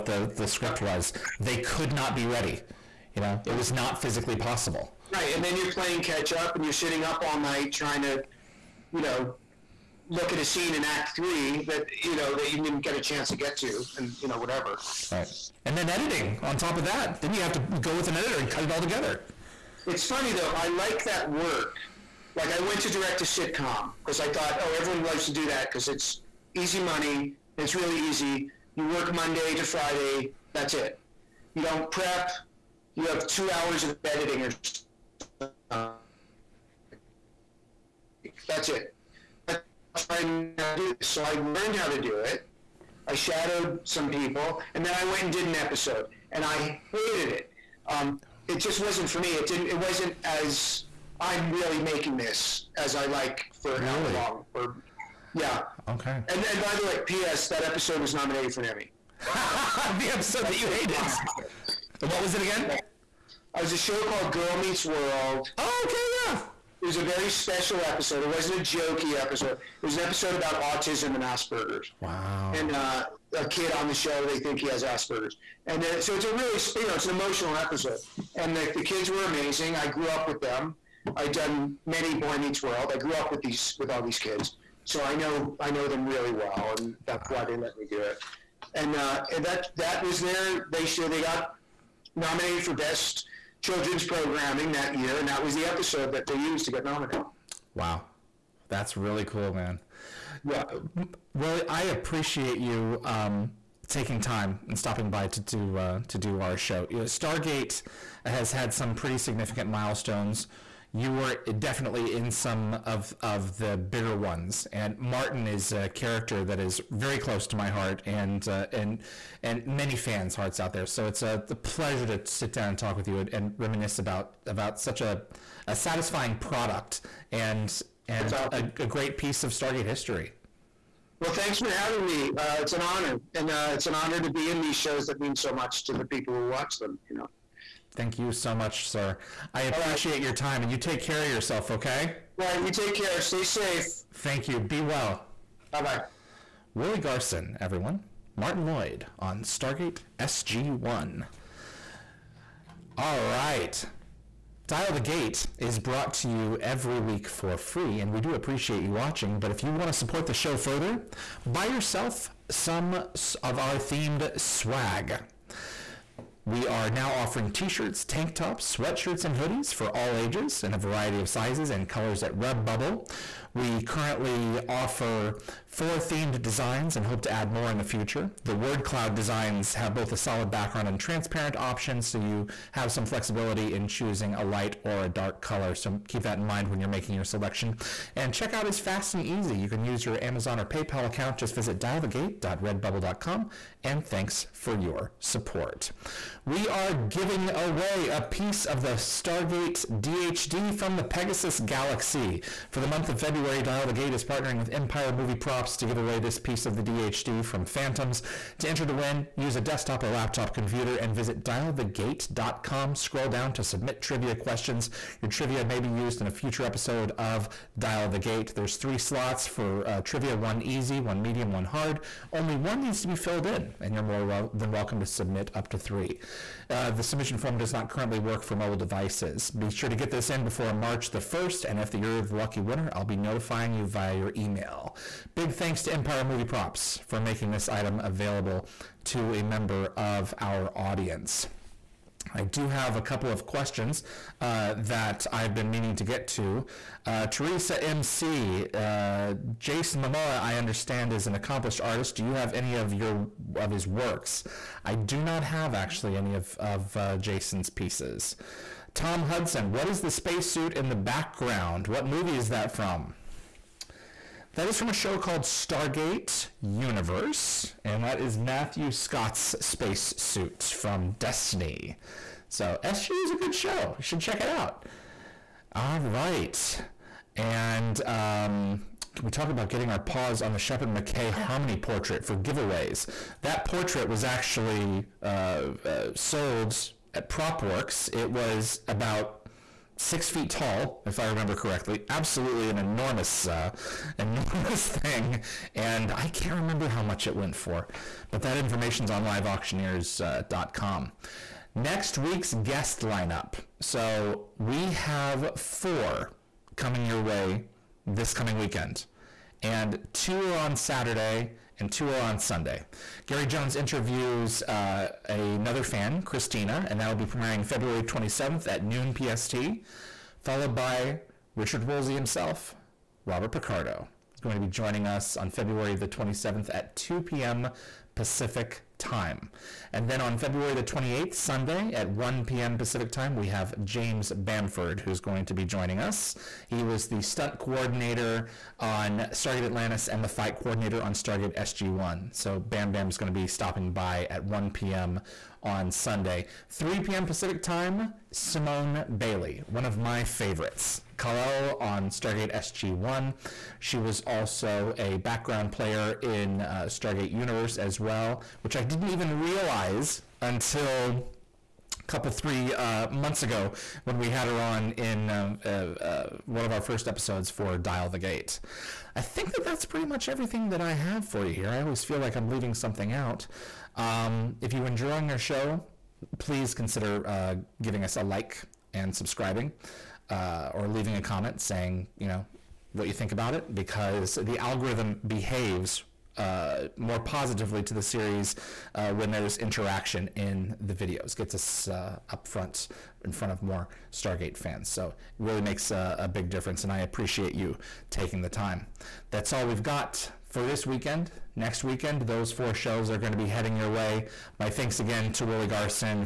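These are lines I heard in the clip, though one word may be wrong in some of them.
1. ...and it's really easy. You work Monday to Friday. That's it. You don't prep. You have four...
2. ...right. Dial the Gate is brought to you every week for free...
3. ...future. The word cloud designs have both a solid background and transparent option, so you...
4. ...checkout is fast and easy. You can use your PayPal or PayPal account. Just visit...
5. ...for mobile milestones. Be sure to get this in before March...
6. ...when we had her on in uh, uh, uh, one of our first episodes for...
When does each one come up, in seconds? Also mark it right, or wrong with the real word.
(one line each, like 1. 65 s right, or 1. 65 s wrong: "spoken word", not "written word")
1. 27 s wrong: "two", not "four"
2. 153 s right
3. 177 s right
4. 188 s wrong: "Amazon", not "PayPal"
5. 228 s wrong: "devices", not "milestones"
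6. 364 s right.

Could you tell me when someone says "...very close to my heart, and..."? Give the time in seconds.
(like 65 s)
116 s.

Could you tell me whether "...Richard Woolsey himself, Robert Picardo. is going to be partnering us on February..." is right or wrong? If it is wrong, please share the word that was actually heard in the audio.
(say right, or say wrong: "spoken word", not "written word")
wrong: "joining", not "partnering".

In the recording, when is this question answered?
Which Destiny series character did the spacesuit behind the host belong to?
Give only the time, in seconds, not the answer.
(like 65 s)
268 s.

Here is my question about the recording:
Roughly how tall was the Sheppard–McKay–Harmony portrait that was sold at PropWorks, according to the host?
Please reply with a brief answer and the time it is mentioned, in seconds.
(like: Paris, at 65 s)
6 feet, at 289 s.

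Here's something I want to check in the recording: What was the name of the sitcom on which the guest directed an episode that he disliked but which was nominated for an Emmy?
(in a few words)
Girl Meets World.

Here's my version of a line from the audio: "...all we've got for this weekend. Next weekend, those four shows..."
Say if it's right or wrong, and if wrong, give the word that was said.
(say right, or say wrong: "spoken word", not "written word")
right.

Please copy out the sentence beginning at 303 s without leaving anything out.
So we have four coming your way this coming weekend, and two are on Saturday and two are on Sunday.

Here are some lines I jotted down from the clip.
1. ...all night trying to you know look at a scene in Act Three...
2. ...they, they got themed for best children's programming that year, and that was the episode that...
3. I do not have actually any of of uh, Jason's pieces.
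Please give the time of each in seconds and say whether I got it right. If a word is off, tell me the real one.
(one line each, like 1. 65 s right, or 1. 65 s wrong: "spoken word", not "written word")
1. 7 s right
2. 90 s wrong: "nominated", not "themed"
3. 254 s right.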